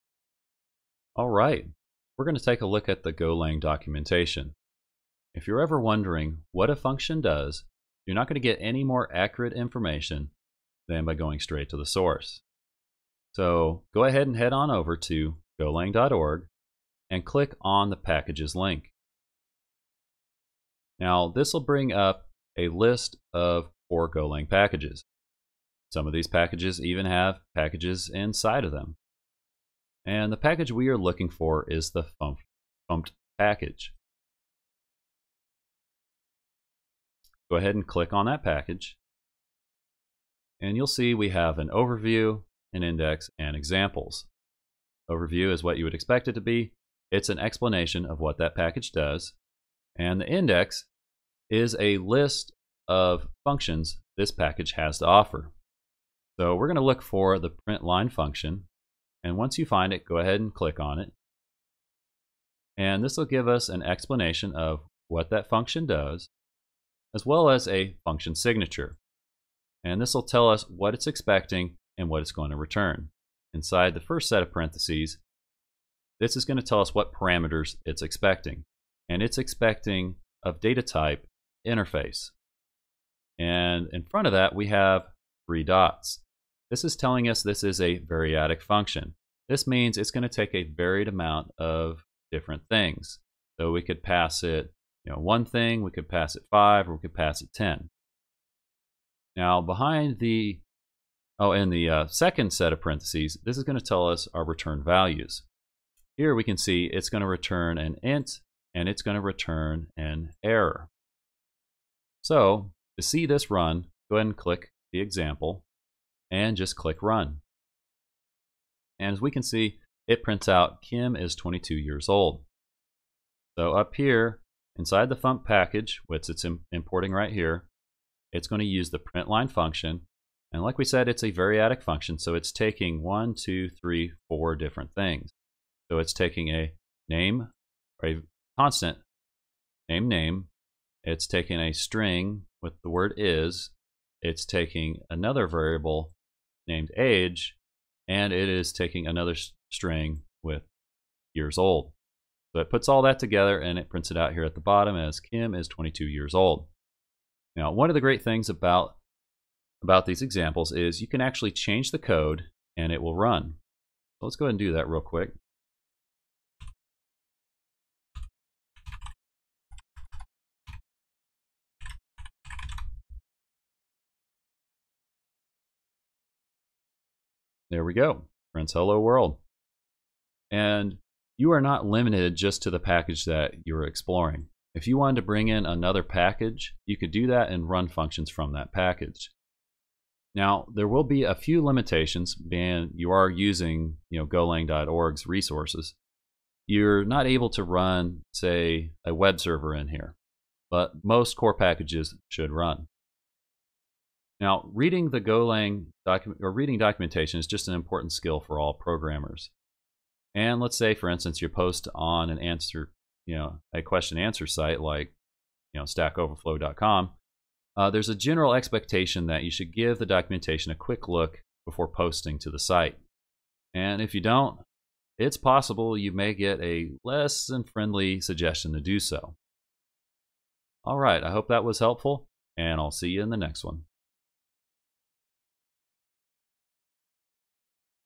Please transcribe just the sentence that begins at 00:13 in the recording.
So go ahead and head on over to golang.org and click on the packages link.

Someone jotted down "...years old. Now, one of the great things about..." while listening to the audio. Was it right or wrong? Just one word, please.
right.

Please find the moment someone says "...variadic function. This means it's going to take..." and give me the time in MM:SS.
01:27.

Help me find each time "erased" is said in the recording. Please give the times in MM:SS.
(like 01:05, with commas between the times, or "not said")
not said.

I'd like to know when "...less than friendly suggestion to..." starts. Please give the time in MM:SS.
03:47.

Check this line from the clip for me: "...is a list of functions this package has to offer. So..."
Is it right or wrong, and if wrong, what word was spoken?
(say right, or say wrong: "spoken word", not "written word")
right.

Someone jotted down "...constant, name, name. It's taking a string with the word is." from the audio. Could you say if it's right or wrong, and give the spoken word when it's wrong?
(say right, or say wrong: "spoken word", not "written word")
right.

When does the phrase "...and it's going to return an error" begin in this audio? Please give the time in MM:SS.
01:48.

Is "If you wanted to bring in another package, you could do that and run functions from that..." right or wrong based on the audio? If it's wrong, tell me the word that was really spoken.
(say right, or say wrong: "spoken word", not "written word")
right.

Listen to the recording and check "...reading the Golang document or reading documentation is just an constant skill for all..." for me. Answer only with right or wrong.
wrong.